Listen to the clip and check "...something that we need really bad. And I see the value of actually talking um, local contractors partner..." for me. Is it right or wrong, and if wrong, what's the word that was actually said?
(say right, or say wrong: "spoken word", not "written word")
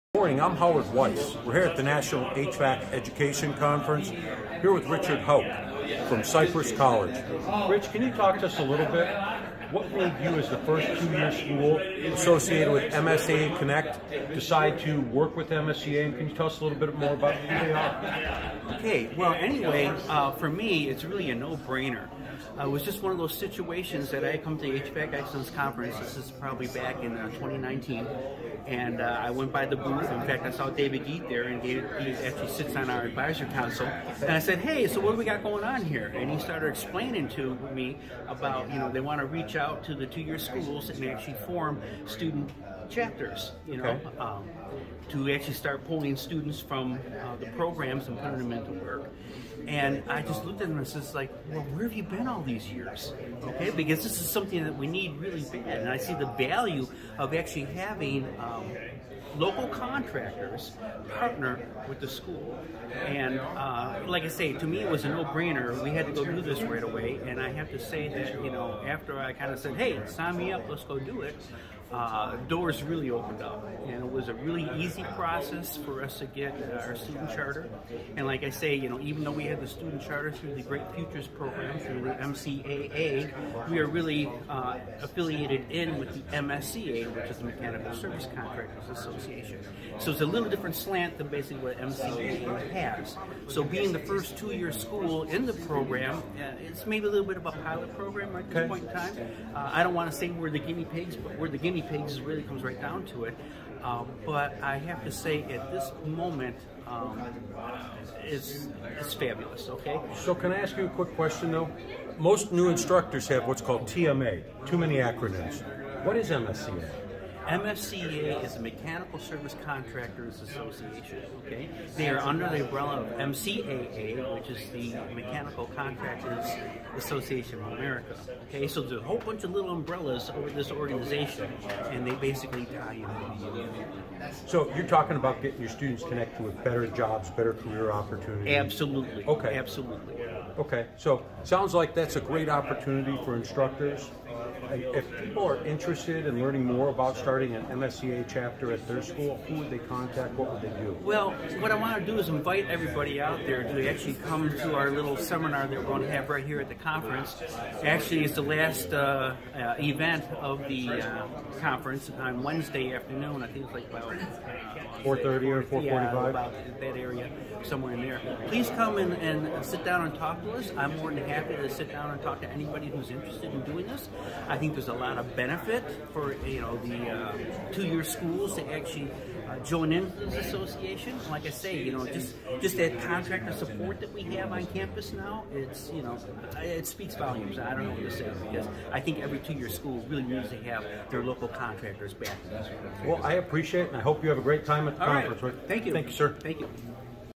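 wrong: "having", not "talking".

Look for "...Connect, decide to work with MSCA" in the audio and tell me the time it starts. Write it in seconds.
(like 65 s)
13 s.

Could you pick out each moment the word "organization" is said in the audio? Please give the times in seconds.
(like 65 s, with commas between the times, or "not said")
130 s.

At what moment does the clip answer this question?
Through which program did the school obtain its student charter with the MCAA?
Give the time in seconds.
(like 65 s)
80 s.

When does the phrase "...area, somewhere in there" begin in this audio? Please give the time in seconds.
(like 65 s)
166 s.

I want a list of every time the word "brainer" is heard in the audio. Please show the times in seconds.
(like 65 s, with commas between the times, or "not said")
21 s, 65 s.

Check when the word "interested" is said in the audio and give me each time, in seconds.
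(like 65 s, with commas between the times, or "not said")
145 s, 173 s.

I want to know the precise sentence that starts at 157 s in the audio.
Actually, it's the last uh, uh, event of the uh, conference on Wednesday afternoon.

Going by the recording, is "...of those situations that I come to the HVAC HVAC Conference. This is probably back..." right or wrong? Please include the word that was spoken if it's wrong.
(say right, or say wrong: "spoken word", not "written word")
wrong: "Excellence", not "HVAC".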